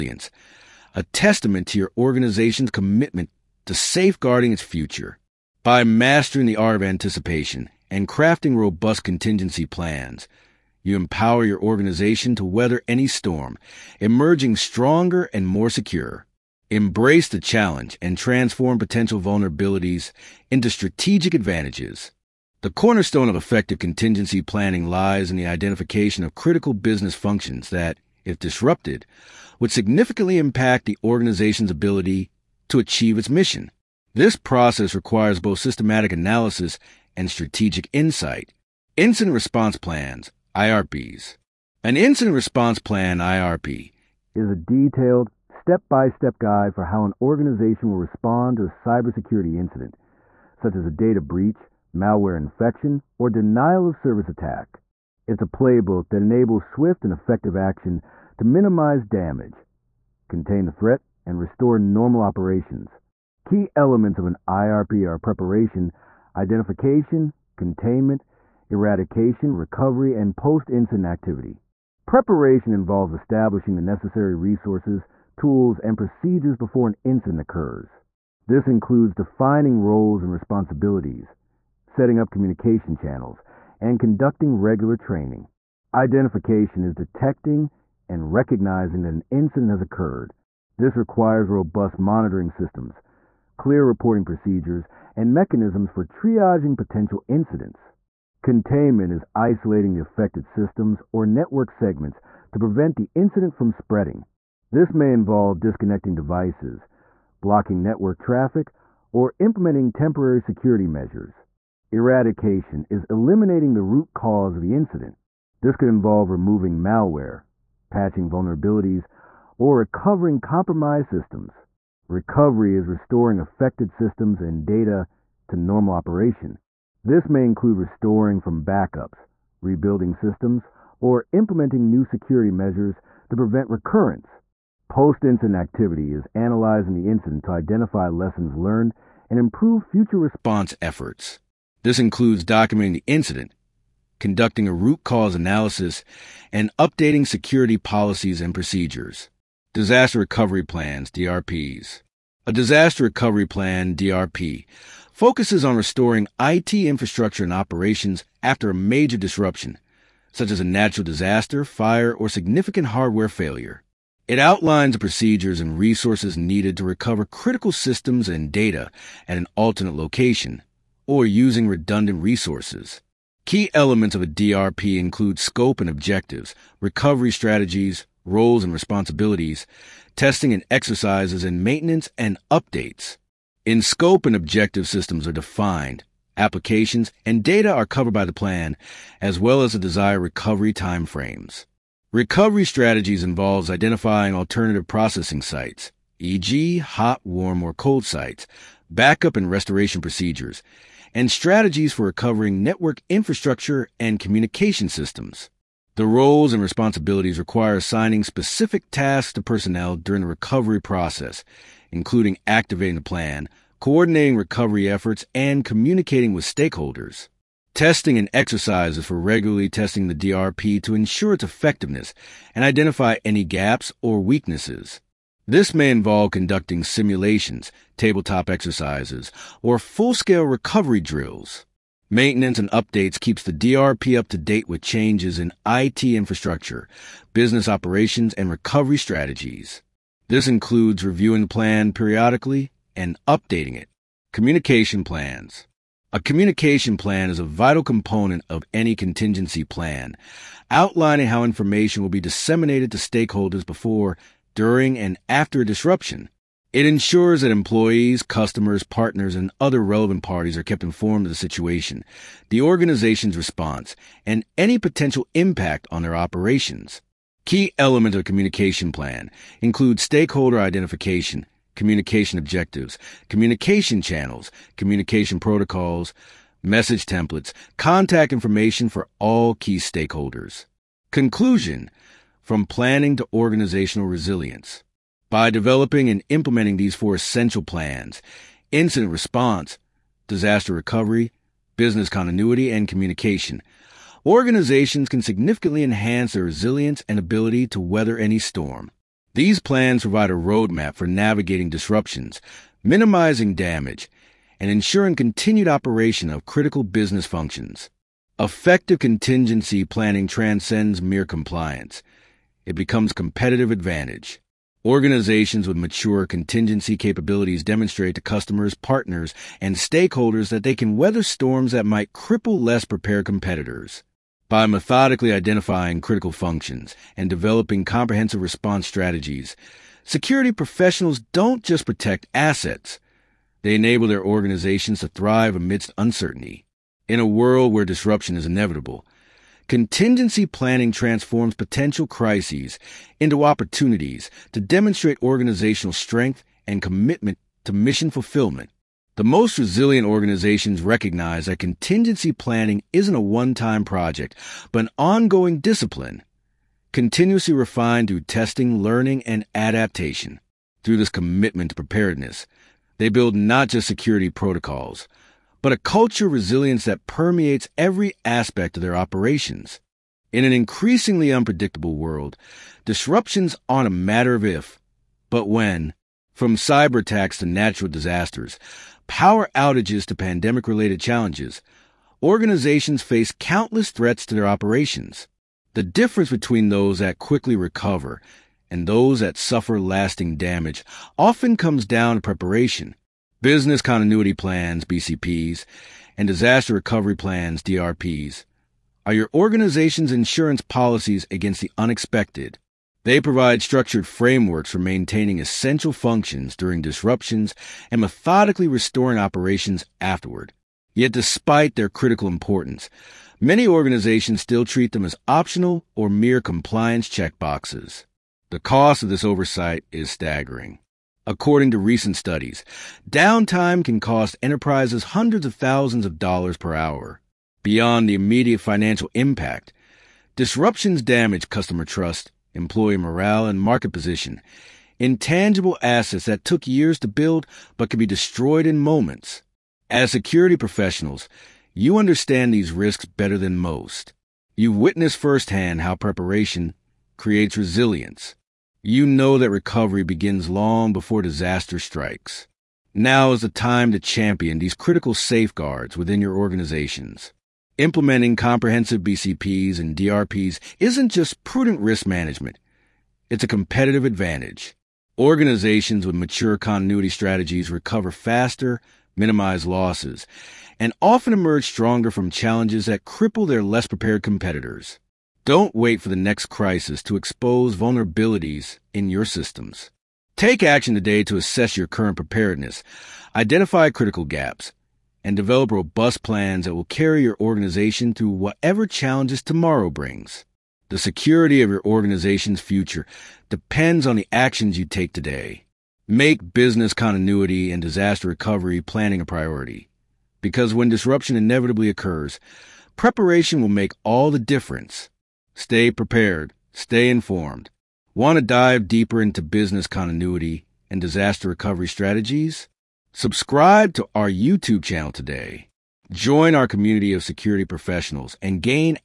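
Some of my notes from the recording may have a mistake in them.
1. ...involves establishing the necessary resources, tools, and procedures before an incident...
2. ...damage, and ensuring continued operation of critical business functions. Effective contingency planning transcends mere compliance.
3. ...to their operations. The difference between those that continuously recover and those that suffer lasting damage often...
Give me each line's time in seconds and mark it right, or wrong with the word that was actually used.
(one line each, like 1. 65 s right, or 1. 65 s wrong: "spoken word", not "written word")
1. 72 s right
2. 303 s right
3. 384 s wrong: "quickly", not "continuously".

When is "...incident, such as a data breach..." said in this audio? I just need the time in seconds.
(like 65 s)
49 s.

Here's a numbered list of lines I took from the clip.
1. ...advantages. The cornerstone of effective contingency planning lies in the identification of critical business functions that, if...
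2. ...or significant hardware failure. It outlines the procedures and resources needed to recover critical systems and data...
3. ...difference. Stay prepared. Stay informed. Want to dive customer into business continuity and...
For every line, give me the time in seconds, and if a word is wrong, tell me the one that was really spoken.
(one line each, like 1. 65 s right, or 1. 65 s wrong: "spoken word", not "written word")
1. 21 s right
2. 162 s right
3. 504 s wrong: "deeper", not "customer".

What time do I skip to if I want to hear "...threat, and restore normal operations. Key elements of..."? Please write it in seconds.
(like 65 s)
60 s.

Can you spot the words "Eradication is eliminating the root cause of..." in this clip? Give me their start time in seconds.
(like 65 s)
111 s.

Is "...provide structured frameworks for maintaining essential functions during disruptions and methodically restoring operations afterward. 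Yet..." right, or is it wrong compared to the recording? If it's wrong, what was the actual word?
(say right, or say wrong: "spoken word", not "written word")
right.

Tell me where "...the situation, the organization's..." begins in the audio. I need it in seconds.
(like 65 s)
261 s.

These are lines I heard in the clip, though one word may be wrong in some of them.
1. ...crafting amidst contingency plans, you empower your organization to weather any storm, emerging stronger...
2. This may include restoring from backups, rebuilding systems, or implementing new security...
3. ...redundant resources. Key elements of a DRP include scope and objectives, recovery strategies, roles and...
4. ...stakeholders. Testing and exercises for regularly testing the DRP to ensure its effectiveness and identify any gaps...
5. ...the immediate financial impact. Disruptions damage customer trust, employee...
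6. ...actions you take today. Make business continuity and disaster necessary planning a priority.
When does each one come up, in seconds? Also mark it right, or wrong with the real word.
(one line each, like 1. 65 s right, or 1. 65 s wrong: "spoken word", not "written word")
1. 8 s wrong: "robust", not "amidst"
2. 127 s right
3. 171 s right
4. 216 s right
5. 428 s right
6. 494 s wrong: "recovery", not "necessary".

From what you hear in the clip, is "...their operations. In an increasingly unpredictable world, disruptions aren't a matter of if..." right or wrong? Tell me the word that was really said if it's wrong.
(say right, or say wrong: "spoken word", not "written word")
right.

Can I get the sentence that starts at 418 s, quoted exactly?
The cost of this oversight is staggering according to recent studies.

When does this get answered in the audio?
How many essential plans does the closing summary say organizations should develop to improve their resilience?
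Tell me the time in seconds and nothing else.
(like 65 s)
286 s.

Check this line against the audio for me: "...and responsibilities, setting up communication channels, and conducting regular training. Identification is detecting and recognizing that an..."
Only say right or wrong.
right.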